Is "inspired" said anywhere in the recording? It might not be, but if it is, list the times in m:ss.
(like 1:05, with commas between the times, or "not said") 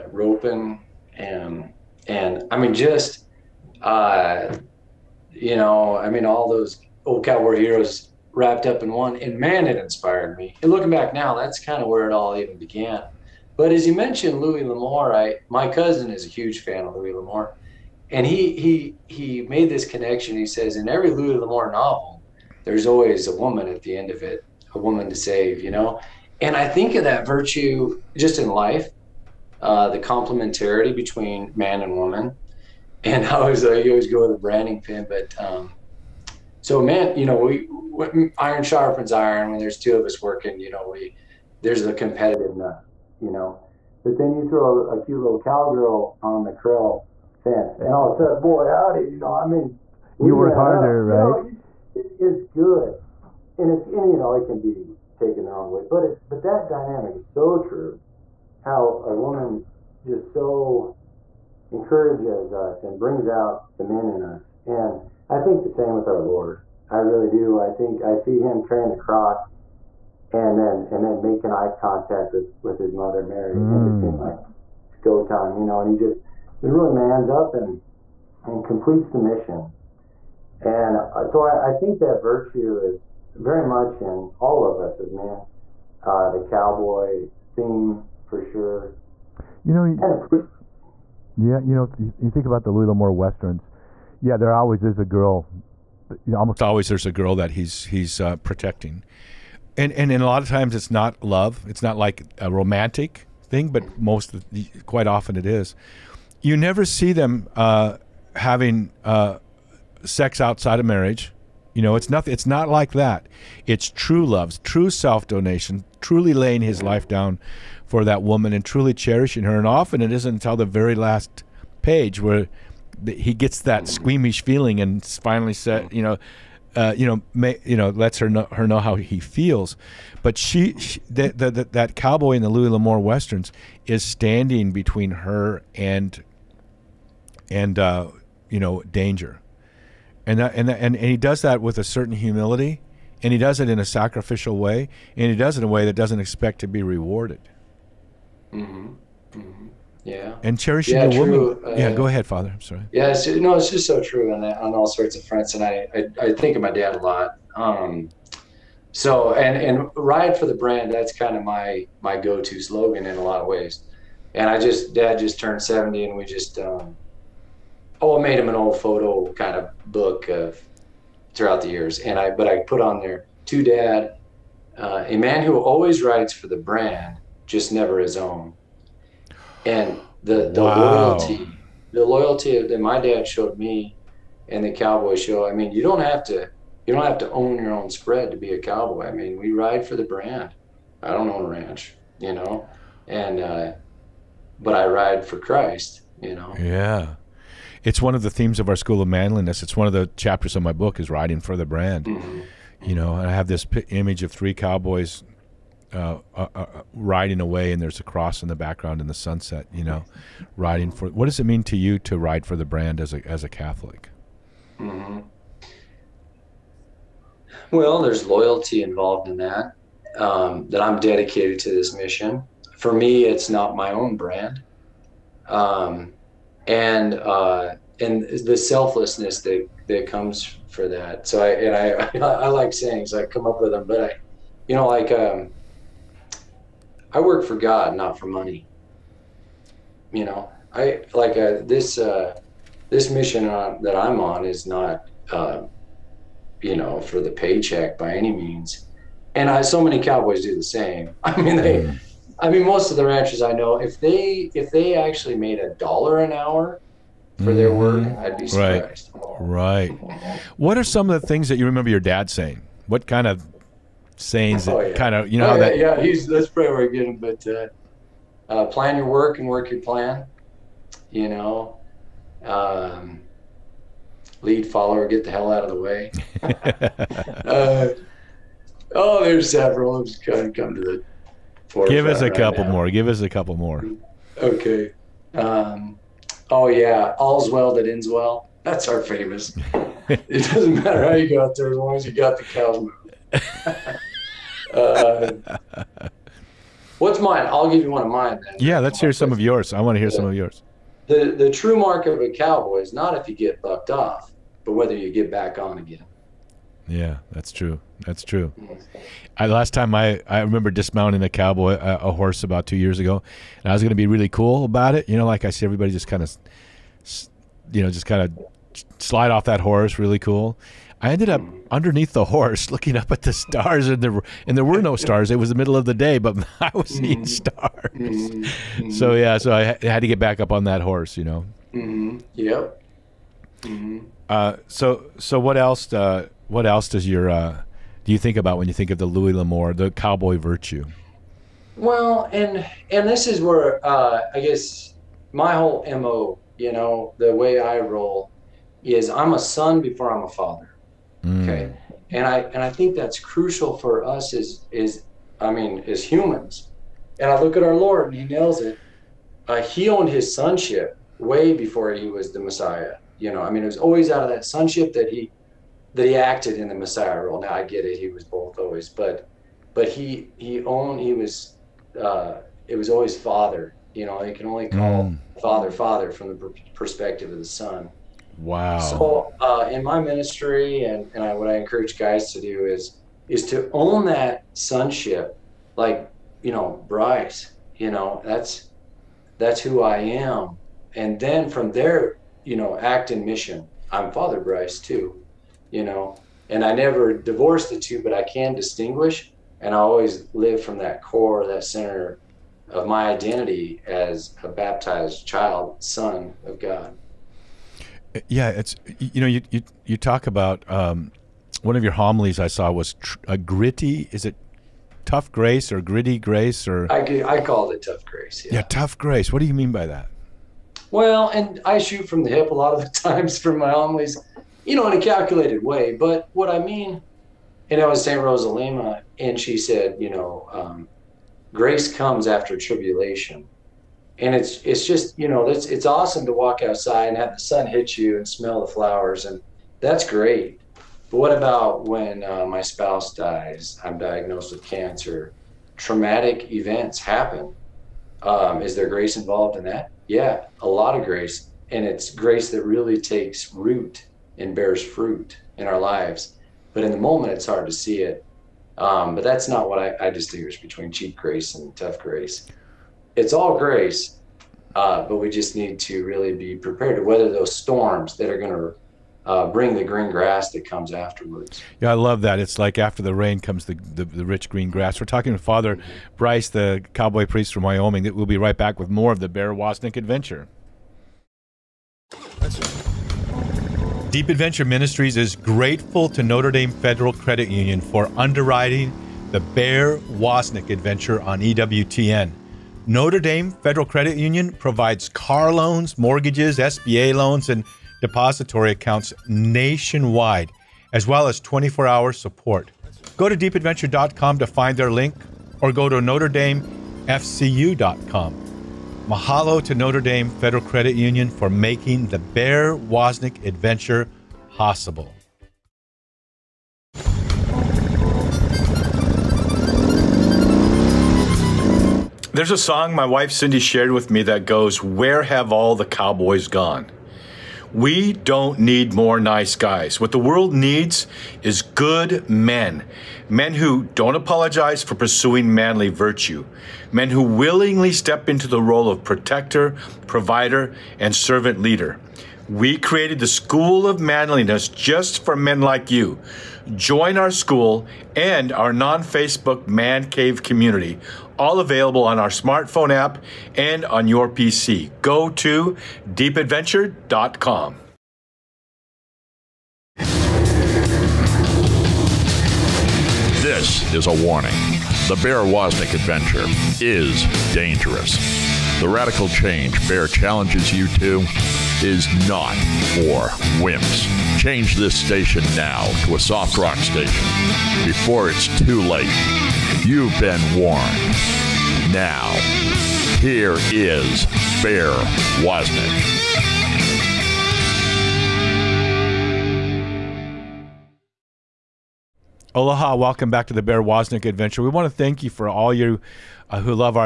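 0:09.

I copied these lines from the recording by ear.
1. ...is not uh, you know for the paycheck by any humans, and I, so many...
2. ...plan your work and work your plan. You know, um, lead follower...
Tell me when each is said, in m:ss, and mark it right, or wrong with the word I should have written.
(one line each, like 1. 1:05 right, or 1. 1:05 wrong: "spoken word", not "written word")
1. 4:04 wrong: "means", not "humans"
2. 4:28 right.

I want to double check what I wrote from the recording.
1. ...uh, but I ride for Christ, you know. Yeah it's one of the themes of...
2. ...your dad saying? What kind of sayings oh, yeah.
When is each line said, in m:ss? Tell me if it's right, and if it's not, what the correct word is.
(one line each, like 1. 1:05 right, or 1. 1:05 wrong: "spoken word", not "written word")
1. 3:13 right
2. 4:21 right.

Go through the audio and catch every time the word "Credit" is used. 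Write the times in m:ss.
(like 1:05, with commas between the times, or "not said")
8:07, 8:13, 8:30.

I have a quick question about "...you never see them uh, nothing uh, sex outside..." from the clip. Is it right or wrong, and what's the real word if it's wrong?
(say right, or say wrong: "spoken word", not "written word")
wrong: "having", not "nothing".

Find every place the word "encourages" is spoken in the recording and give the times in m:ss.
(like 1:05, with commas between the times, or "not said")
1:01, 6:21.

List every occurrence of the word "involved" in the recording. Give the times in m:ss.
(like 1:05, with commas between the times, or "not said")
3:38, 7:29.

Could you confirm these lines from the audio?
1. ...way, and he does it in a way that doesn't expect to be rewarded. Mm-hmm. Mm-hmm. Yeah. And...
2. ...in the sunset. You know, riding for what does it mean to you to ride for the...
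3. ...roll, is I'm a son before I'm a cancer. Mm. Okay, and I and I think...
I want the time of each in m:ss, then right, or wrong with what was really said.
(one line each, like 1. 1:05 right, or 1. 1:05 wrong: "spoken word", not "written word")
1. 2:24 right
2. 3:28 right
3. 5:47 wrong: "father", not "cancer".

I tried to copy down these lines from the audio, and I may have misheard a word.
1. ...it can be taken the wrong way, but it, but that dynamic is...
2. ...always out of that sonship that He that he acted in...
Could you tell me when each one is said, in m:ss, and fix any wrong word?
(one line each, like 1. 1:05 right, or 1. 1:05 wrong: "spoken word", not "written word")
1. 0:54 right
2. 6:03 right.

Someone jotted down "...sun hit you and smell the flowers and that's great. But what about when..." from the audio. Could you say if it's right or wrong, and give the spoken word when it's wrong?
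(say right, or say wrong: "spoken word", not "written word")
right.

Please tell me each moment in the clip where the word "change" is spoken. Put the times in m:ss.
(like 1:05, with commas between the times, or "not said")
9:29, 9:34.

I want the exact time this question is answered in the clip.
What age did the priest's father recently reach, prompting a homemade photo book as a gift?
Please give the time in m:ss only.
2:45.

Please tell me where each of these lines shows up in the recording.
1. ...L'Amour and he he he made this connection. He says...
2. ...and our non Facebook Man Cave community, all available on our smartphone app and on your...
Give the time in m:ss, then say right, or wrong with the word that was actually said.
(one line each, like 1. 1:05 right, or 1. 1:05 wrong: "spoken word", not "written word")
1. 0:17 right
2. 9:08 right.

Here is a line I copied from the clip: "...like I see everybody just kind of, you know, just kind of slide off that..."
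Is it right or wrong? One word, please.
right.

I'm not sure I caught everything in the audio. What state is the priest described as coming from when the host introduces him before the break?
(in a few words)
Wyoming.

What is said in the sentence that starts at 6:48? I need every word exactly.
Yeah, it's you know you you, you talk about um, one of your homilies I saw was tr- a gritty.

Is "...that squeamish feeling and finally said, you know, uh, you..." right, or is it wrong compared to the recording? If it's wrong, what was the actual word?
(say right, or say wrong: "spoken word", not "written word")
right.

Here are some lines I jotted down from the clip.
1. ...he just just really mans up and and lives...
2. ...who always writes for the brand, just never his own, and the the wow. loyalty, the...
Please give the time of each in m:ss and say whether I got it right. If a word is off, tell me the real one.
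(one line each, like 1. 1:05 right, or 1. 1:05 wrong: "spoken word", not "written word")
1. 1:15 wrong: "completes", not "lives"
2. 2:55 right.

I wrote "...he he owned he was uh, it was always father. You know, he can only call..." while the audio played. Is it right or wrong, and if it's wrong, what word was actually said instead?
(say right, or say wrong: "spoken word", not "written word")
right.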